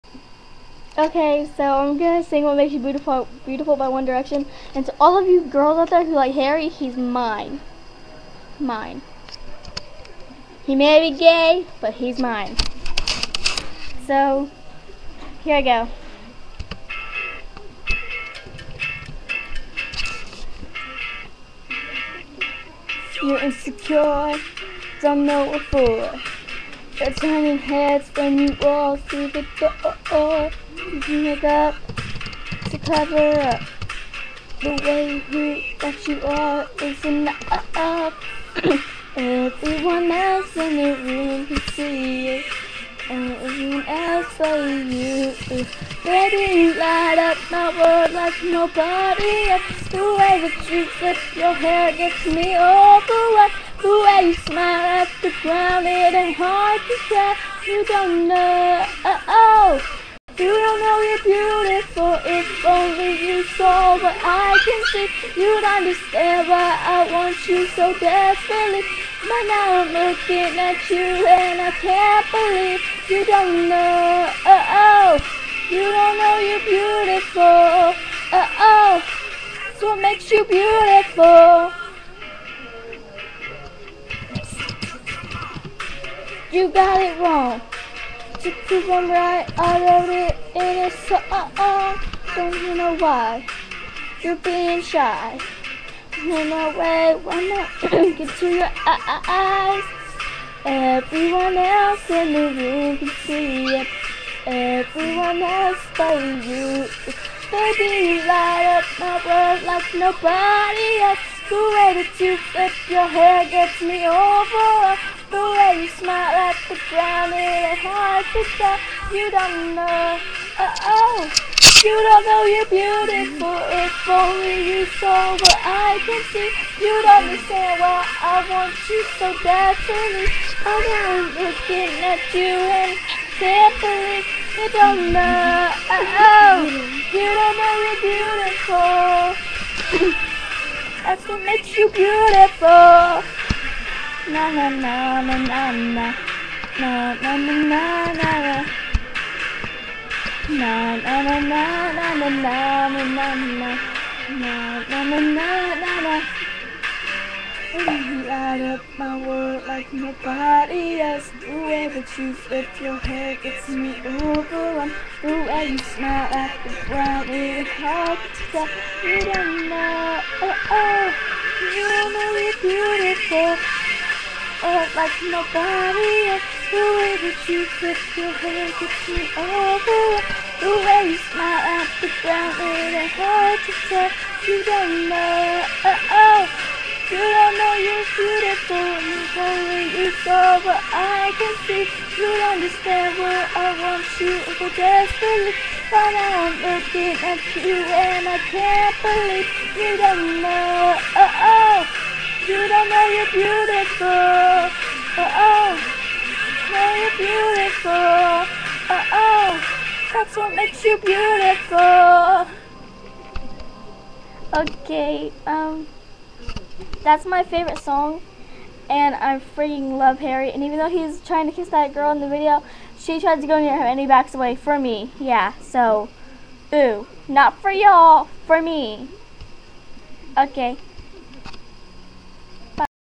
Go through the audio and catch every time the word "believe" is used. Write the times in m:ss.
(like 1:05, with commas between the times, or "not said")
1:12, 3:19.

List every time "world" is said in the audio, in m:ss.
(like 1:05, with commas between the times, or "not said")
0:47, 1:49, 2:39.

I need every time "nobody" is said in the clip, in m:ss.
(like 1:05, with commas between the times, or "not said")
0:48, 1:49, 2:39, 2:55.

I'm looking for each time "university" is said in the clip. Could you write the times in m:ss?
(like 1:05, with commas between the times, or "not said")
not said.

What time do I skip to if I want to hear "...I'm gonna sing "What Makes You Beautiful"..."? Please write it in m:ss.
0:01.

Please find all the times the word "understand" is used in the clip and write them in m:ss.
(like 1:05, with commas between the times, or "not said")
1:05, 2:07, 3:12.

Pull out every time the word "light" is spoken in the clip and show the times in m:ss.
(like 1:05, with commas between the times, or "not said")
0:46, 1:48, 2:38.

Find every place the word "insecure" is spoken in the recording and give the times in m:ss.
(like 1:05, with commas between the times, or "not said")
0:23.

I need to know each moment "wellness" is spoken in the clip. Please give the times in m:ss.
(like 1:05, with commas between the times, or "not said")
not said.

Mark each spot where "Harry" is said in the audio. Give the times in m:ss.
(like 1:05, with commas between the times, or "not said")
0:06, 3:40.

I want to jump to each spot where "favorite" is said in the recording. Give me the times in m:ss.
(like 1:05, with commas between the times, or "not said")
3:37.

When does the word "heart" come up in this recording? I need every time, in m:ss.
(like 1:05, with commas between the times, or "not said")
1:57.